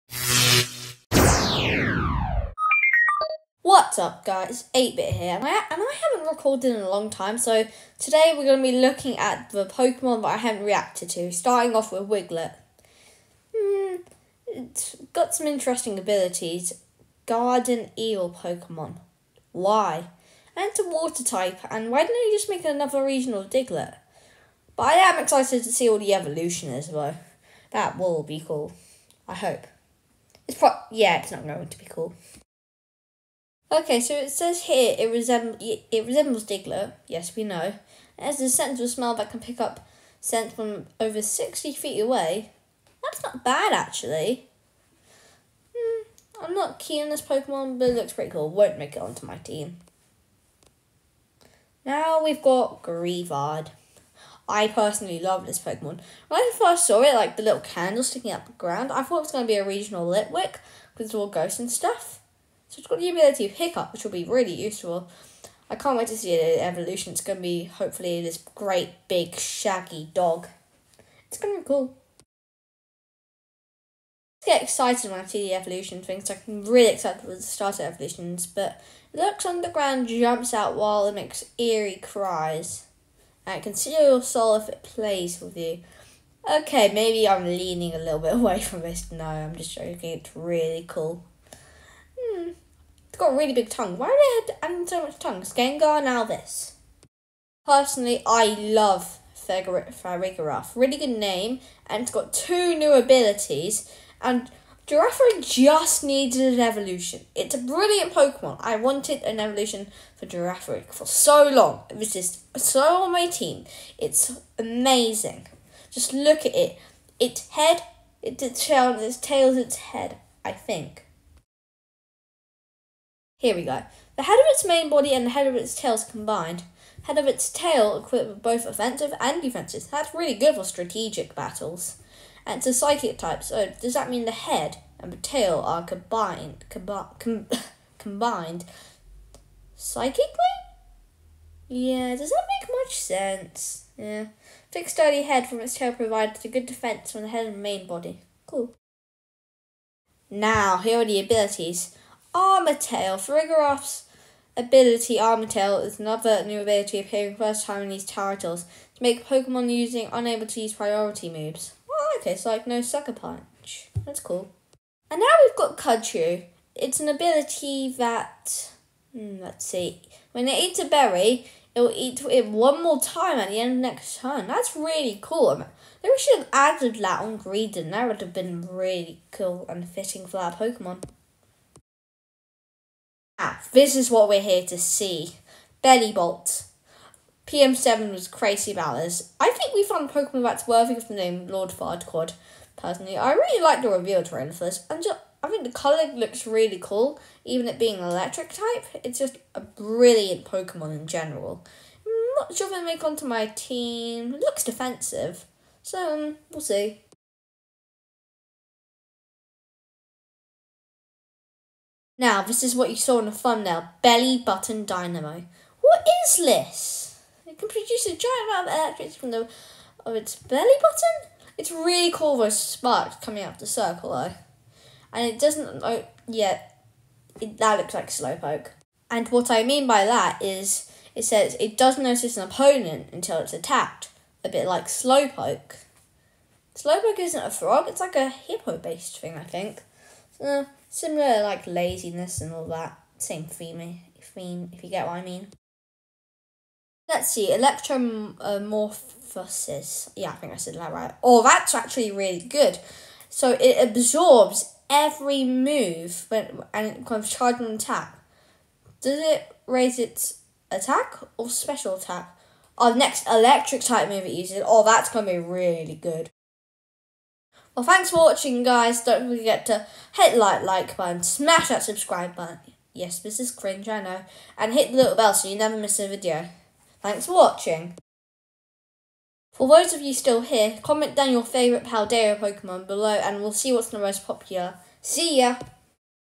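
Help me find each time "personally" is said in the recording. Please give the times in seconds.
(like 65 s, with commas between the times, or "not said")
54 s, 97 s, 192 s.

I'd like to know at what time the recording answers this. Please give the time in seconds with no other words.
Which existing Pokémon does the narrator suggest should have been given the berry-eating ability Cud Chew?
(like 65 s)
177 s.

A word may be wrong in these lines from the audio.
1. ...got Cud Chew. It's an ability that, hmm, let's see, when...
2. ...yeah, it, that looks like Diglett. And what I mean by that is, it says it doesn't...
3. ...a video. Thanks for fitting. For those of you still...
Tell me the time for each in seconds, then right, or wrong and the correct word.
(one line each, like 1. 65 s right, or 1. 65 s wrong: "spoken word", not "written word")
1. 165 s right
2. 226 s wrong: "Slowpoke", not "Diglett"
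3. 275 s wrong: "watching", not "fitting".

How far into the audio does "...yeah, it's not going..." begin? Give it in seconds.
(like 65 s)
30 s.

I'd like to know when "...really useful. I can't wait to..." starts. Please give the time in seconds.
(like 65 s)
64 s.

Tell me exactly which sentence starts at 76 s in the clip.
So I'm really excited with the starter evolutions, but it looks underground, jumps out while it makes eerie cries.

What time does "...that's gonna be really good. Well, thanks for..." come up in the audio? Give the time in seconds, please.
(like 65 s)
264 s.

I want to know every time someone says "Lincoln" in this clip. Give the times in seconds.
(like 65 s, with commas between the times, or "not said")
not said.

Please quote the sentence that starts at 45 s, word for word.
Hmm, I'm not keen on this Pokemon, but it looks pretty cool.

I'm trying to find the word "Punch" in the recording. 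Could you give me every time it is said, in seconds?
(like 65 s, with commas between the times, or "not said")
163 s.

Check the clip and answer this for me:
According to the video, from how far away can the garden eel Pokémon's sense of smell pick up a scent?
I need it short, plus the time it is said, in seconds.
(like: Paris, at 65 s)
60 feet, at 41 s.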